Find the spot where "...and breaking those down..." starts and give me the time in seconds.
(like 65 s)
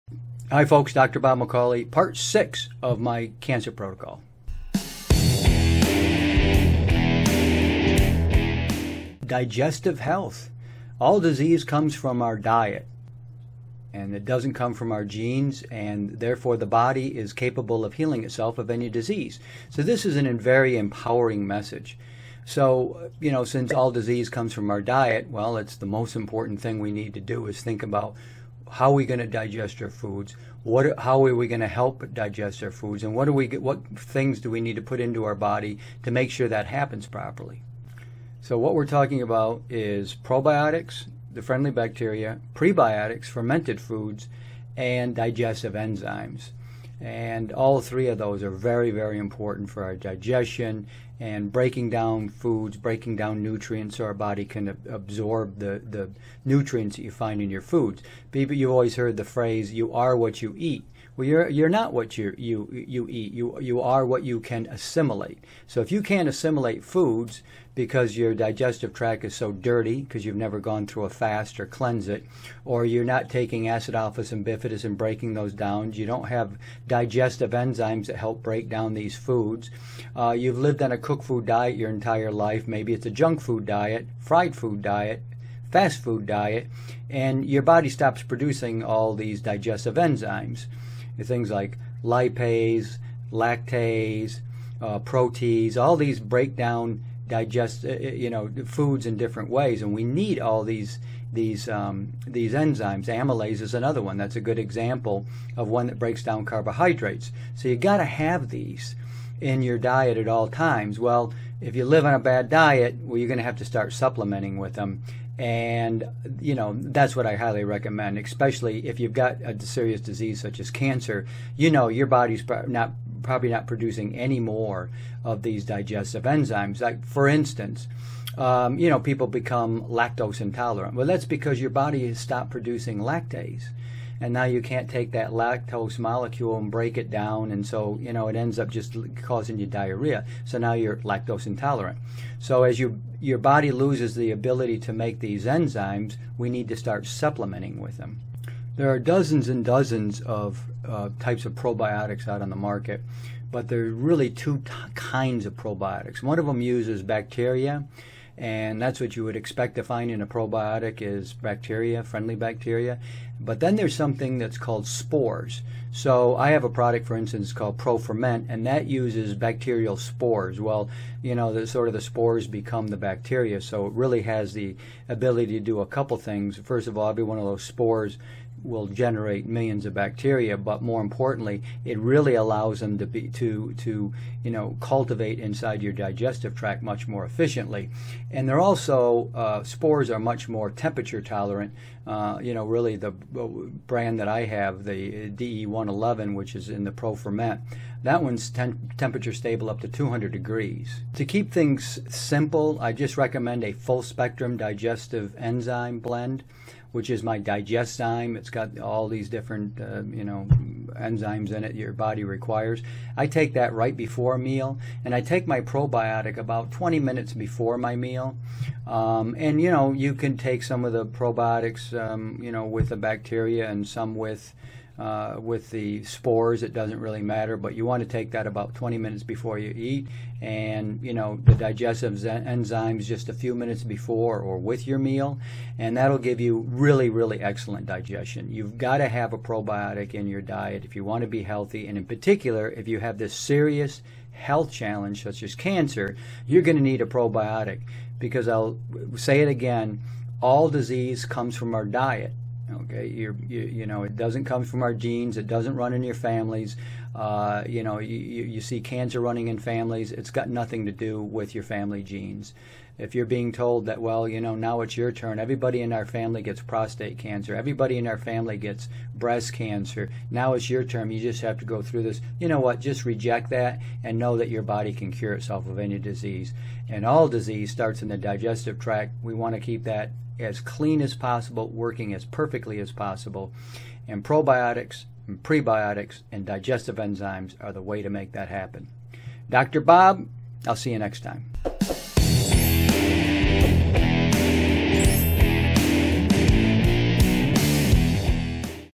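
74 s.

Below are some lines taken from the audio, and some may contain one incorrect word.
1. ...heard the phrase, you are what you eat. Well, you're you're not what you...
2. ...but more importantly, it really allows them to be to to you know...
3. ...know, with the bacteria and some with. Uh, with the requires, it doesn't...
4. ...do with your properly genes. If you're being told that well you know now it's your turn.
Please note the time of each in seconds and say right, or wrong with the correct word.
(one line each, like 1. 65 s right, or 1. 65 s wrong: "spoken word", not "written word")
1. 58 s right
2. 180 s right
3. 222 s wrong: "spores", not "requires"
4. 260 s wrong: "family", not "properly".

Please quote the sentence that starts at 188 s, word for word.
And they're also uh, spores are much more temperature tolerant.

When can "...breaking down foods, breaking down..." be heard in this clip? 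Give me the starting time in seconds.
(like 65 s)
51 s.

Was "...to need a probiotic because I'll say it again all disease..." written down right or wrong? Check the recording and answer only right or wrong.
right.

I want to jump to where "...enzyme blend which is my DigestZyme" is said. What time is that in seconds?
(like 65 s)
205 s.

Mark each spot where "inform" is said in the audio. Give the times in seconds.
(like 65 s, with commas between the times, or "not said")
not said.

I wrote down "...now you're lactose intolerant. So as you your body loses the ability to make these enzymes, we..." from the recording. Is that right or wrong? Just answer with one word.
right.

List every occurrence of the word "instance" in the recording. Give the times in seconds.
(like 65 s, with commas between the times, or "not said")
127 s, 167 s.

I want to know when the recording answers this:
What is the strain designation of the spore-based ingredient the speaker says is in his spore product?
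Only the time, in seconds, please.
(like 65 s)
195 s.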